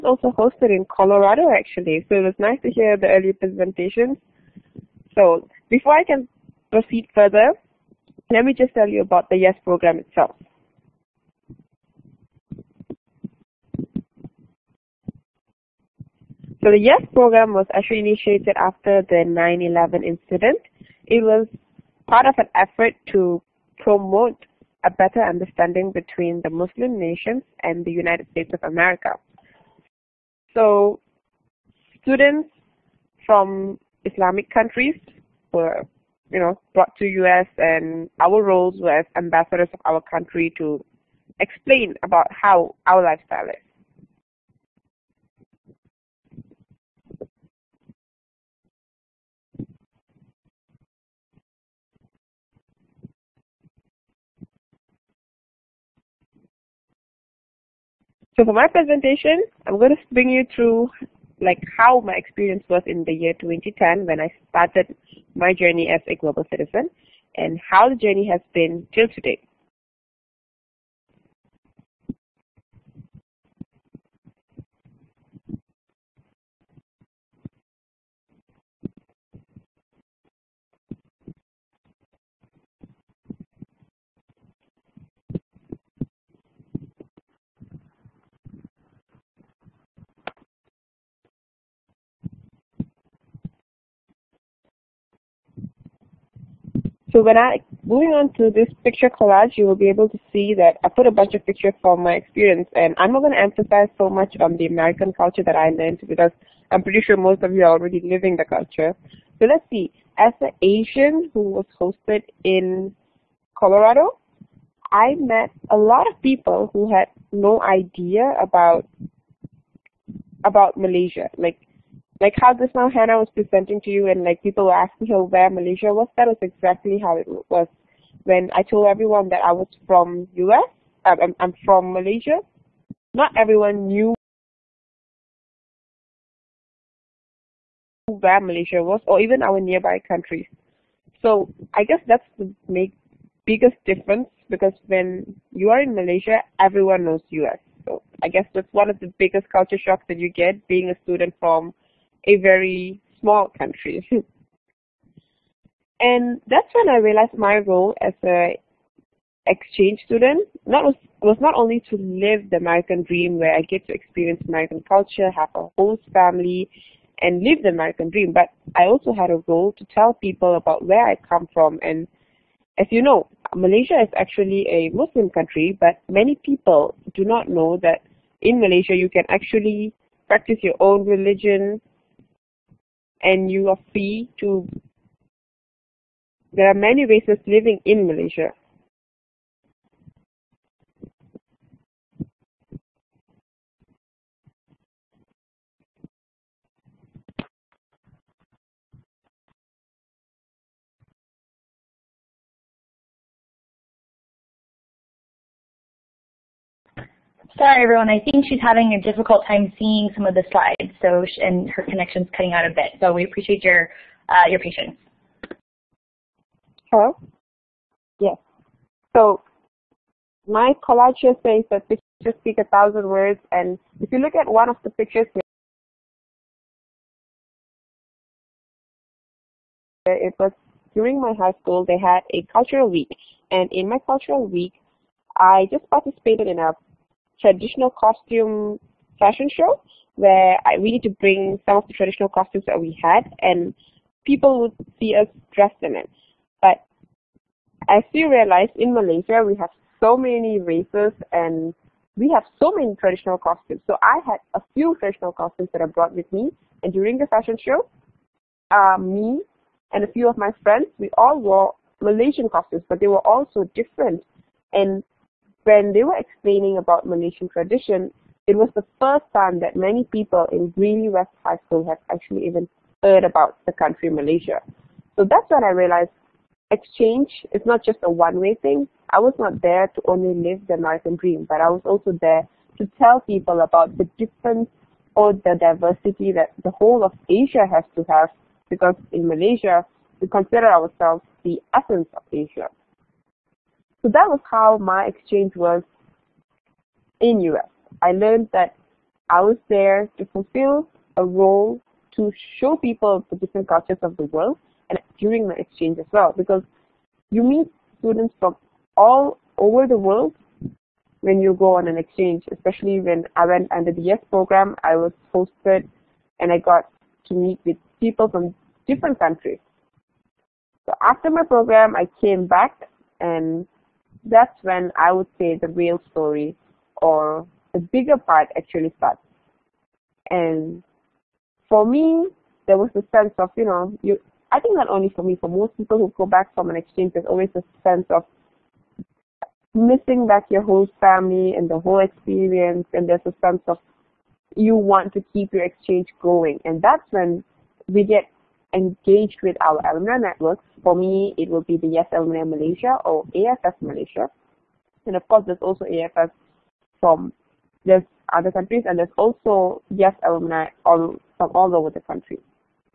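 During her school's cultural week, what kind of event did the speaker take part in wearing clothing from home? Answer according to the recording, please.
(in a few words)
Traditional costume fashion show.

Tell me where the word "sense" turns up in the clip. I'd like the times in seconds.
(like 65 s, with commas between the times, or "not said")
333 s, 337 s, 343 s.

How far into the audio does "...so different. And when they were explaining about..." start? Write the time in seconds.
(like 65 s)
263 s.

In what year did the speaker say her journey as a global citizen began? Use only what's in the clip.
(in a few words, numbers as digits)
2010.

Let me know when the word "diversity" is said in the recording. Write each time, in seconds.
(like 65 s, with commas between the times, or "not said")
285 s.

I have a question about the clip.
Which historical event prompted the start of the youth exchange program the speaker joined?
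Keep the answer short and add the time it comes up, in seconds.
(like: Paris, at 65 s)
9-11, at 19 s.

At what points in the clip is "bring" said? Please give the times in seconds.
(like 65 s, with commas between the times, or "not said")
60 s, 241 s.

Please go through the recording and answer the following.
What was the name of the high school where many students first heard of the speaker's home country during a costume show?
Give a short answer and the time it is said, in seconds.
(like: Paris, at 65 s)
Greeley West High School, at 270 s.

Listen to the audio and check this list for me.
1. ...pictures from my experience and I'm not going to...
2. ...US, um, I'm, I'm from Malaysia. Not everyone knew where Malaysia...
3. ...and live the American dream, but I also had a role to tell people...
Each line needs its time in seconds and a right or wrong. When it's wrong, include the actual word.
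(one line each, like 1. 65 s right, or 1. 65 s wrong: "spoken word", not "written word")
1. 101 s right
2. 130 s right
3. 167 s right.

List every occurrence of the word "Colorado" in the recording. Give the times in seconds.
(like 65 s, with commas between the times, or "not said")
0 s, 113 s.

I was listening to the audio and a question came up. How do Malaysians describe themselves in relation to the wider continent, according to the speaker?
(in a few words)
The essence of Asia.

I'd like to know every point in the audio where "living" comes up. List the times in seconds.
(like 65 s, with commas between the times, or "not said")
108 s, 187 s.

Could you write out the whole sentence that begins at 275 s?
So that's when I realized exchange is not just a one-way thing.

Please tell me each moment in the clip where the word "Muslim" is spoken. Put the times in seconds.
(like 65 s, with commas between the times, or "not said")
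26 s, 174 s.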